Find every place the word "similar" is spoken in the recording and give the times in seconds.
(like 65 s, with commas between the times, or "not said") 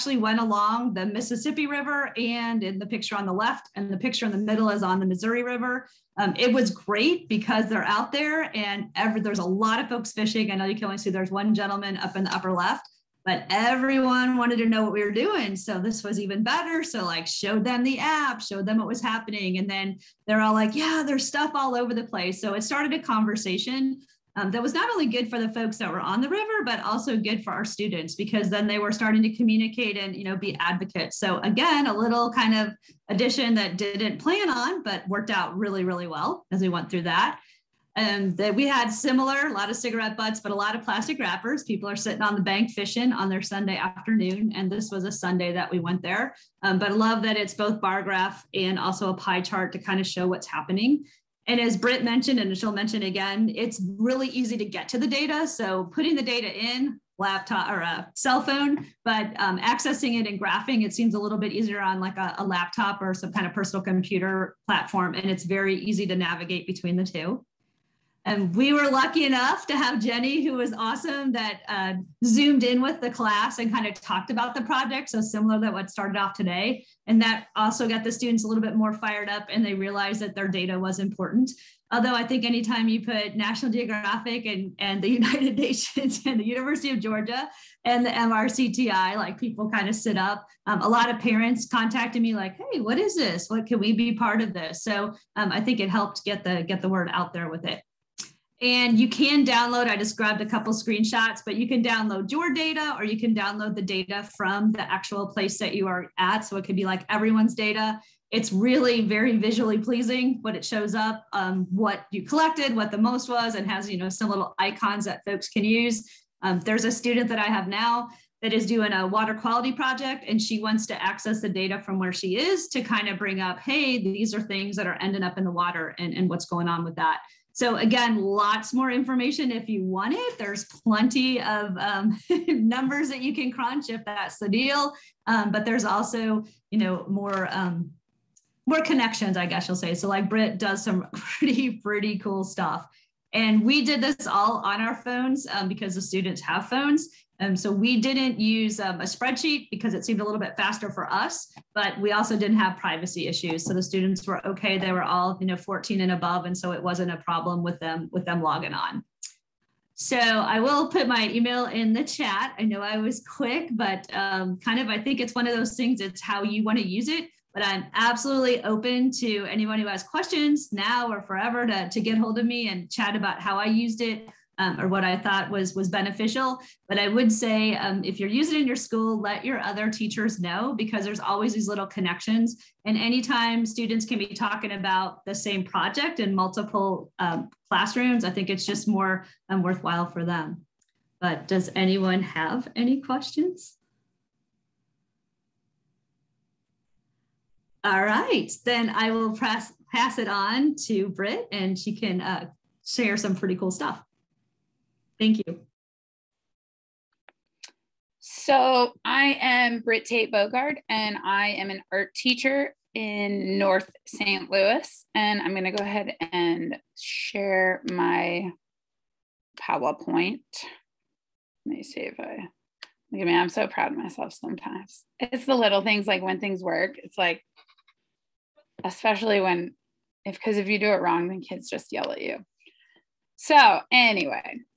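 38 s, 75 s.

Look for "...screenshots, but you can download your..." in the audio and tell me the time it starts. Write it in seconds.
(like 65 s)
100 s.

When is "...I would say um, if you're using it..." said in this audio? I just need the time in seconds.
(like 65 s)
176 s.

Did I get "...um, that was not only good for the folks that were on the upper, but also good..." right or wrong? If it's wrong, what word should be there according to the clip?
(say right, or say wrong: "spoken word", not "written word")
wrong: "river", not "upper".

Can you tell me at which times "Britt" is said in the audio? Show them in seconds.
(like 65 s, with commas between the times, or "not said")
51 s, 140 s, 201 s, 209 s.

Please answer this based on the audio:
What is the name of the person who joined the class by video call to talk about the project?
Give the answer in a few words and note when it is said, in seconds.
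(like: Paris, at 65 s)
Jenny, at 69 s.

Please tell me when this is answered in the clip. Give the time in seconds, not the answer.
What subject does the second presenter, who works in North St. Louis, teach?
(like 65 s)
211 s.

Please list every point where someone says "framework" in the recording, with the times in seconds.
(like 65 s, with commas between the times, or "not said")
not said.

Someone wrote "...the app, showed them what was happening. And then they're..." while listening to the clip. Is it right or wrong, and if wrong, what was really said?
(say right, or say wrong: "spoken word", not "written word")
right.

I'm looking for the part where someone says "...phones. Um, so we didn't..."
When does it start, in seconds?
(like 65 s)
146 s.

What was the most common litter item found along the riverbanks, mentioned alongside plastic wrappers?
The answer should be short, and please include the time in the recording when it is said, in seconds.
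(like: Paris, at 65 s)
Cigarette butts, at 39 s.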